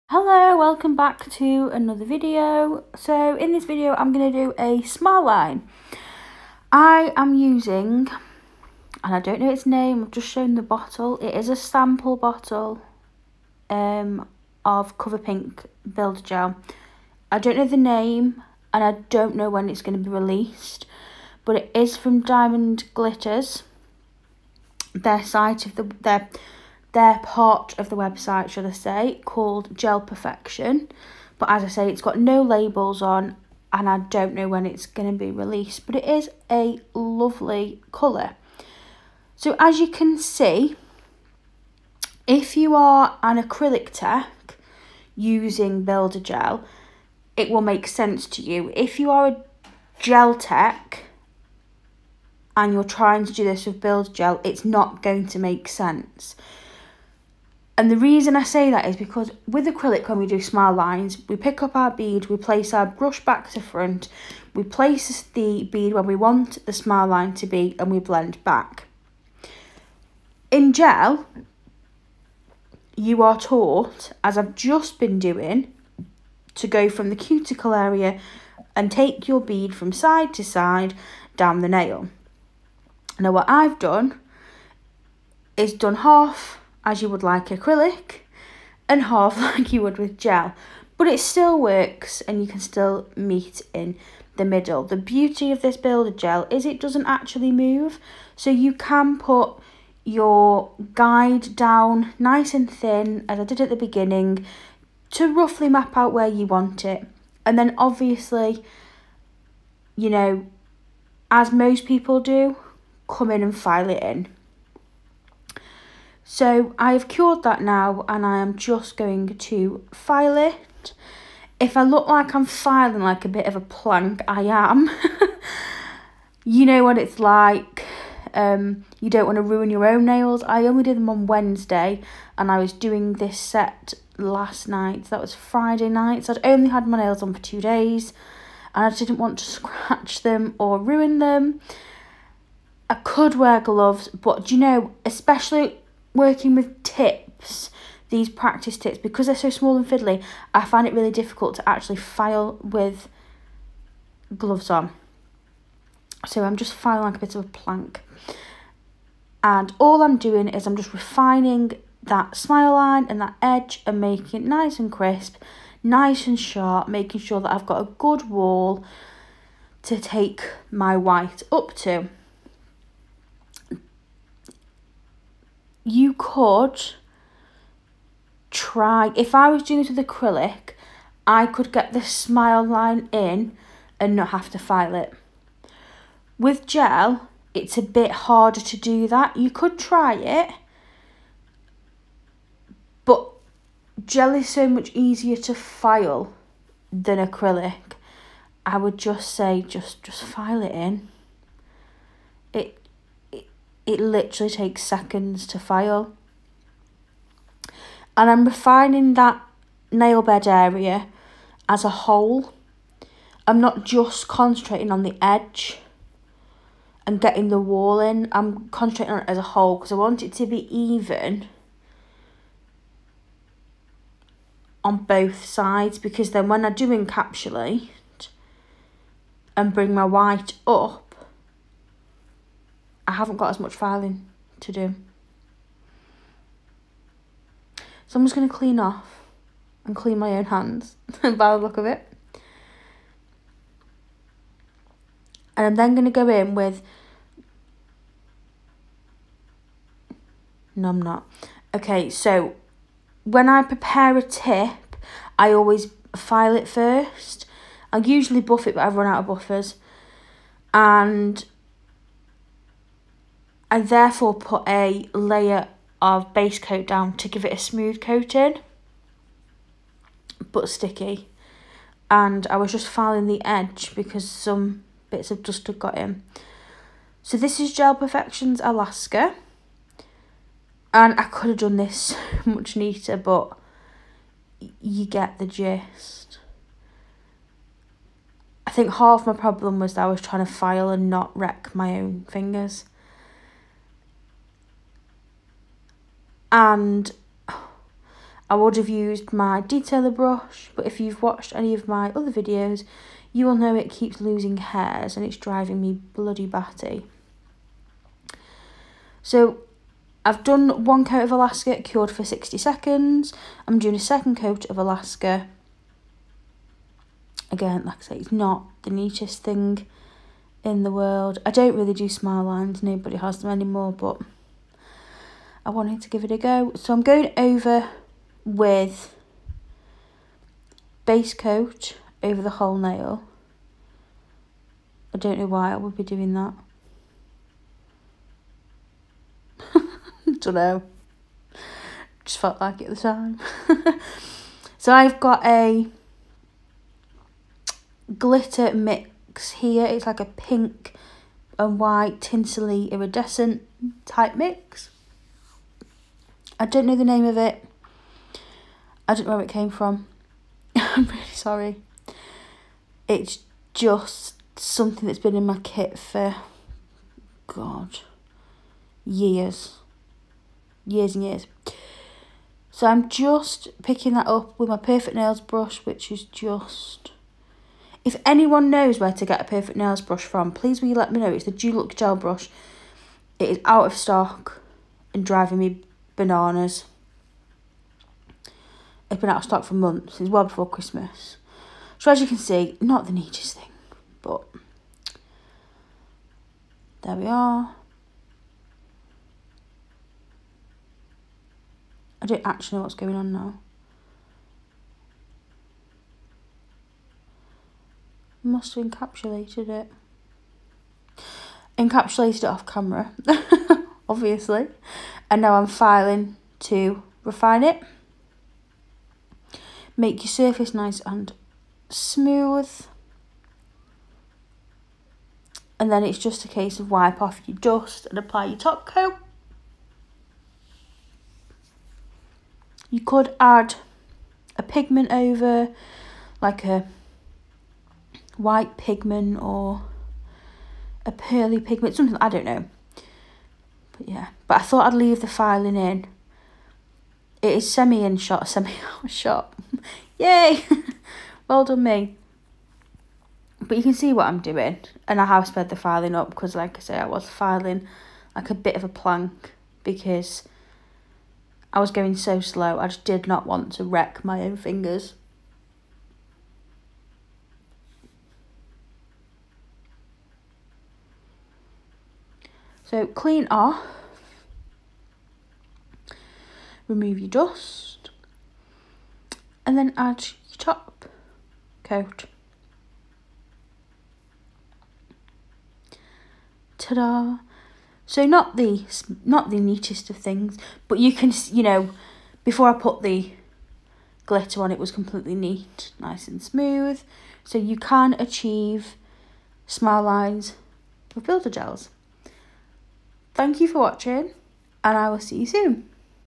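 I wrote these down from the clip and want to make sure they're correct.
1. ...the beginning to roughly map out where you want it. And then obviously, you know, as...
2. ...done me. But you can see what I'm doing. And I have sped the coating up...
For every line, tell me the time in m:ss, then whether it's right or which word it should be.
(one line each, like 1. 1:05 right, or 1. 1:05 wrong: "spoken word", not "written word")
1. 1:43 right
2. 7:31 wrong: "filing", not "coating".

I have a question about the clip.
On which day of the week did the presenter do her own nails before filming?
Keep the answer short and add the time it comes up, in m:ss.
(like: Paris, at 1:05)
Wednesday, at 2:11.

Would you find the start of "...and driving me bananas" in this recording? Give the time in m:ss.
6:25.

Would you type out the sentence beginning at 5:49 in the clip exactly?
It's like a pink and white tinsely iridescent type mix.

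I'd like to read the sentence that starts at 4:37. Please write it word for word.
So this is Gel Perfections Alaska.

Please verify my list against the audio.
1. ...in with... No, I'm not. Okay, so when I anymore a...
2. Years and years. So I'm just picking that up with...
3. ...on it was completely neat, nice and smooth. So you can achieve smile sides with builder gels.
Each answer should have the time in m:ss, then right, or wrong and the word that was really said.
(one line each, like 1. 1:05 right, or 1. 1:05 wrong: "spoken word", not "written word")
1. 4:06 wrong: "prepare", not "anymore"
2. 6:10 right
3. 8:14 wrong: "lines", not "sides".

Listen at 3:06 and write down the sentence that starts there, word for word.
With gel, it's a bit harder to do that.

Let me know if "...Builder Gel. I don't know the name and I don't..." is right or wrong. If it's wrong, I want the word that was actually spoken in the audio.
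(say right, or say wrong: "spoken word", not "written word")
right.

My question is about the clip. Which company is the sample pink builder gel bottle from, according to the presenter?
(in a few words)
Diamond Glitters.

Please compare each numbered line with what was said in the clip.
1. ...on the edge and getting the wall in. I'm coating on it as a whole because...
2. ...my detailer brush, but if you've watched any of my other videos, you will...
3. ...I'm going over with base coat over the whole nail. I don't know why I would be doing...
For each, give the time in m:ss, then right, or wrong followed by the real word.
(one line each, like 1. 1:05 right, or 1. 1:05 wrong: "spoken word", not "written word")
1. 3:34 wrong: "concentrating", not "coating"
2. 4:59 right
3. 5:26 right.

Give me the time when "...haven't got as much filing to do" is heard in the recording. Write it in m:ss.
3:53.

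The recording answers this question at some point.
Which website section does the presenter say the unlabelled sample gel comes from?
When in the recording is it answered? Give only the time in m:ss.
0:29.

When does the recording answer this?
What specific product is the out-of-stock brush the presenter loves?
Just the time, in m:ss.
6:21.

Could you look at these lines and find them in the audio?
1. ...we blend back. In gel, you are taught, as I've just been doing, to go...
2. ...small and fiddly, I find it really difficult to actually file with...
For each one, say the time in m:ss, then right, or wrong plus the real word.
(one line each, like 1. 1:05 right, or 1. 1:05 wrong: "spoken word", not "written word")
1. 1:07 right
2. 2:29 right.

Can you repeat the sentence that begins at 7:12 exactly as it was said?
You could add a pigment over, like a white pigment or a pearly pigment, something I don't know yeah.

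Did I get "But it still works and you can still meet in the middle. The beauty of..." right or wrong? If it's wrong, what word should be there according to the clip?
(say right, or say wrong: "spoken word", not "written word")
right.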